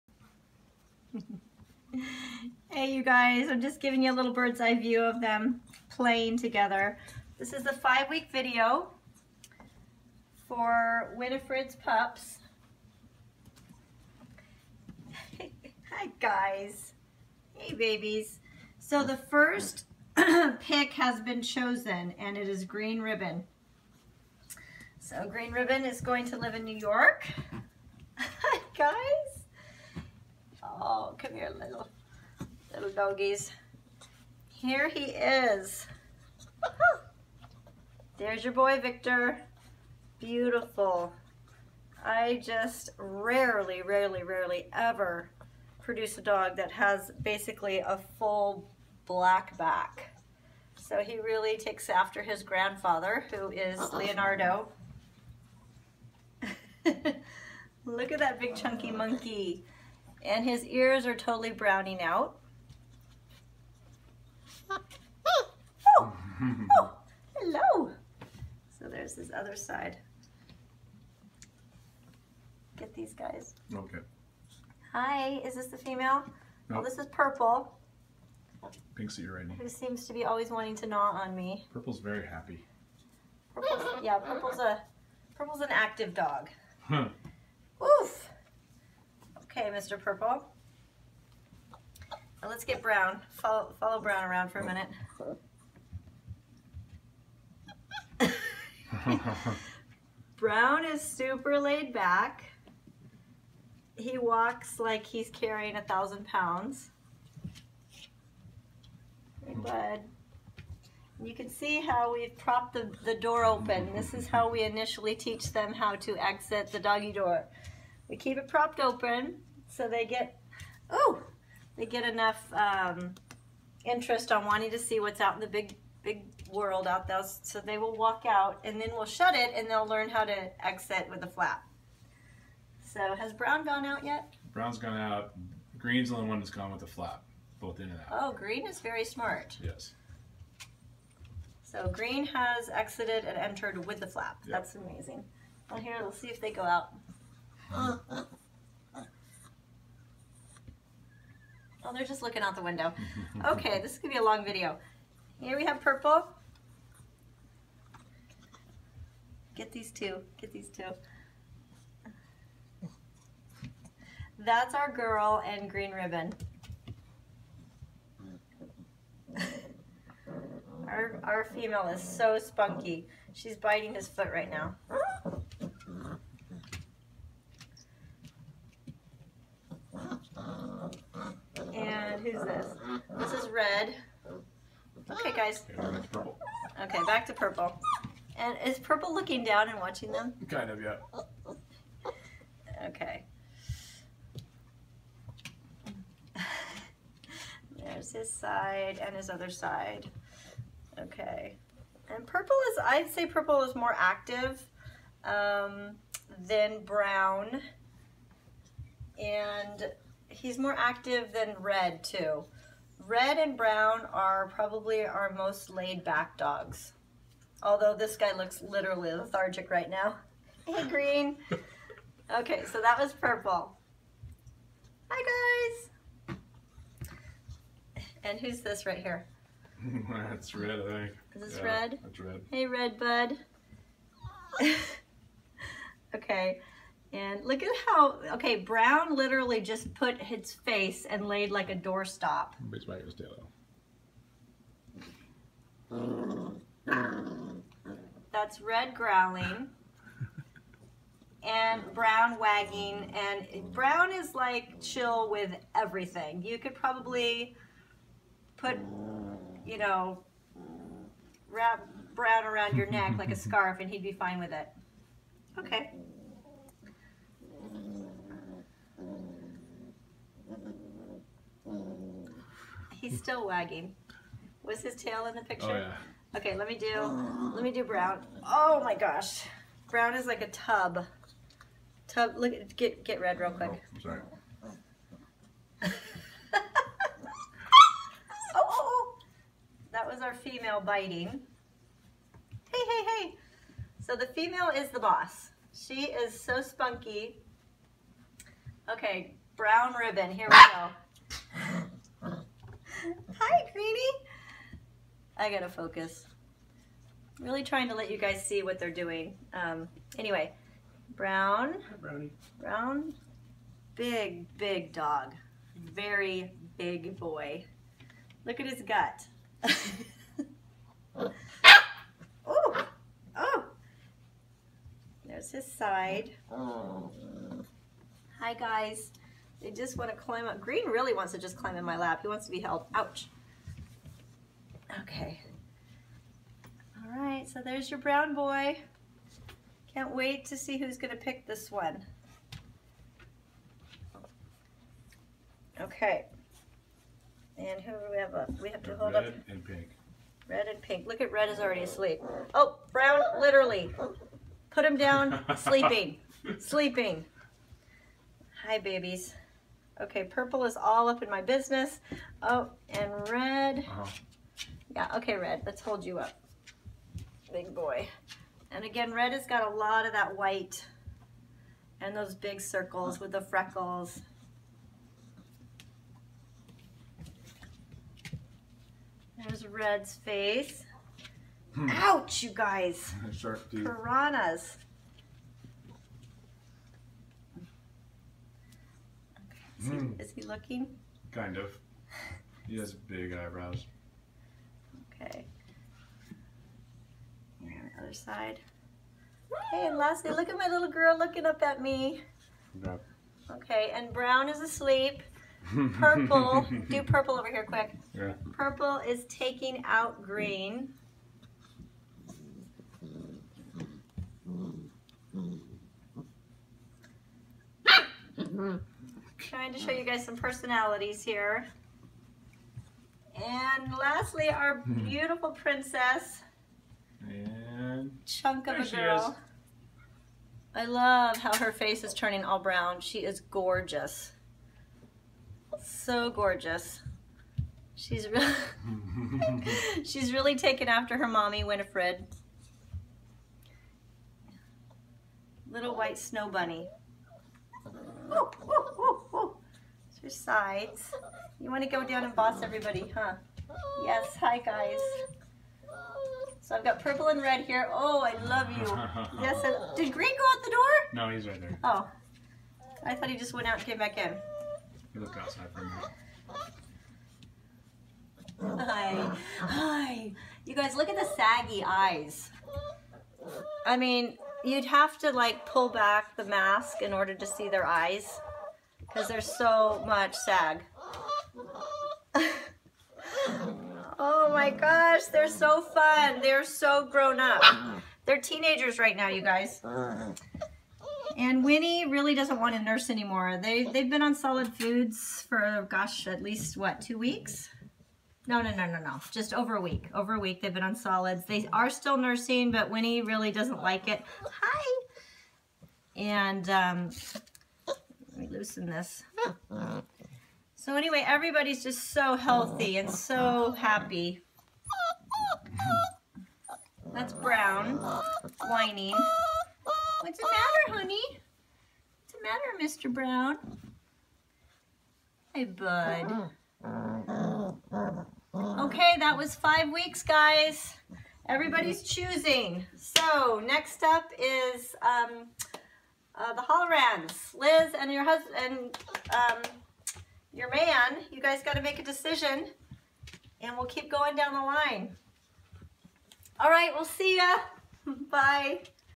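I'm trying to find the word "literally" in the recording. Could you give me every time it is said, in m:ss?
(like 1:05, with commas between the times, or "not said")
3:38, 3:59, 5:53.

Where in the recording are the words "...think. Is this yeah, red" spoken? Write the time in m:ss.
3:50.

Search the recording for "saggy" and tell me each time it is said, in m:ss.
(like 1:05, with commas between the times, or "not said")
7:51.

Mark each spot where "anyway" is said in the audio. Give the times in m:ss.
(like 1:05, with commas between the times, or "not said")
5:10, 8:30.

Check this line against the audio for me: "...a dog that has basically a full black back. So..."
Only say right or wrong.
right.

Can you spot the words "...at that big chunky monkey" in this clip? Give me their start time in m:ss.
0:58.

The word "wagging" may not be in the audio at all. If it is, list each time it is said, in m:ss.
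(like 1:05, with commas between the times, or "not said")
4:12, 4:33.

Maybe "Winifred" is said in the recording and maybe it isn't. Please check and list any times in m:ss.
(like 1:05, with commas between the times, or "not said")
0:11, 7:21.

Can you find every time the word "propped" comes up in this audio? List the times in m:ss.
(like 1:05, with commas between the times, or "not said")
1:52, 1:58.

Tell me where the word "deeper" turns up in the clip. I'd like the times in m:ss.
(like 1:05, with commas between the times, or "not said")
not said.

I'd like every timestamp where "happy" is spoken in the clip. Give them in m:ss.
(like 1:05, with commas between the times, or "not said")
1:22, 8:33.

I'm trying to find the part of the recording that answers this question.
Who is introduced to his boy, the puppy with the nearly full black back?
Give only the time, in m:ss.
0:38.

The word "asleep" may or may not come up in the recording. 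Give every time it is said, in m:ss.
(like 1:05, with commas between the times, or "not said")
5:51, 6:44.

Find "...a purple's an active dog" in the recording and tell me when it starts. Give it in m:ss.
1:24.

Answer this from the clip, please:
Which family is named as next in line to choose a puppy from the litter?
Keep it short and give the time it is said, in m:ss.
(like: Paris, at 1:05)
The Hollorans, at 8:56.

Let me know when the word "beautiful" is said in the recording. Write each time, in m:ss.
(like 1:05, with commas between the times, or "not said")
0:40, 7:05.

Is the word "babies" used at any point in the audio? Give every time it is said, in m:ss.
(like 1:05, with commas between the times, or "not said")
0:17, 5:58.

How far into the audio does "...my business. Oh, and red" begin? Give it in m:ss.
6:01.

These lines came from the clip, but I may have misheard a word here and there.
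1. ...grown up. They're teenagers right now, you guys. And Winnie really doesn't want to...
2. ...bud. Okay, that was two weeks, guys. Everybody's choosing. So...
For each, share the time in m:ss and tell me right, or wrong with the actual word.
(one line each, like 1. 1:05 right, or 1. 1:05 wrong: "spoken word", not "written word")
1. 8:07 right
2. 8:45 wrong: "five", not "two".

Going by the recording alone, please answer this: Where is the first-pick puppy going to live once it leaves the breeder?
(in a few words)
New York.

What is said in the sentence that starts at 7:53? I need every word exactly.
I mean, you'd have to like pull back the mask in order to see their eyes because there's so much sag.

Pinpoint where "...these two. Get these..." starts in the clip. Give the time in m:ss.
2:39.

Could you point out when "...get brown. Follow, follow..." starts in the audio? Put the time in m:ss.
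1:32.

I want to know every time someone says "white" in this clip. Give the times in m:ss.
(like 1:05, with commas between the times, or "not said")
6:10, 7:25.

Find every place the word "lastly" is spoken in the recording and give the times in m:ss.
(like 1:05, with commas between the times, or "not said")
6:39, 7:03.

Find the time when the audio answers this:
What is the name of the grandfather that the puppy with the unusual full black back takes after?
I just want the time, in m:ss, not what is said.
0:53.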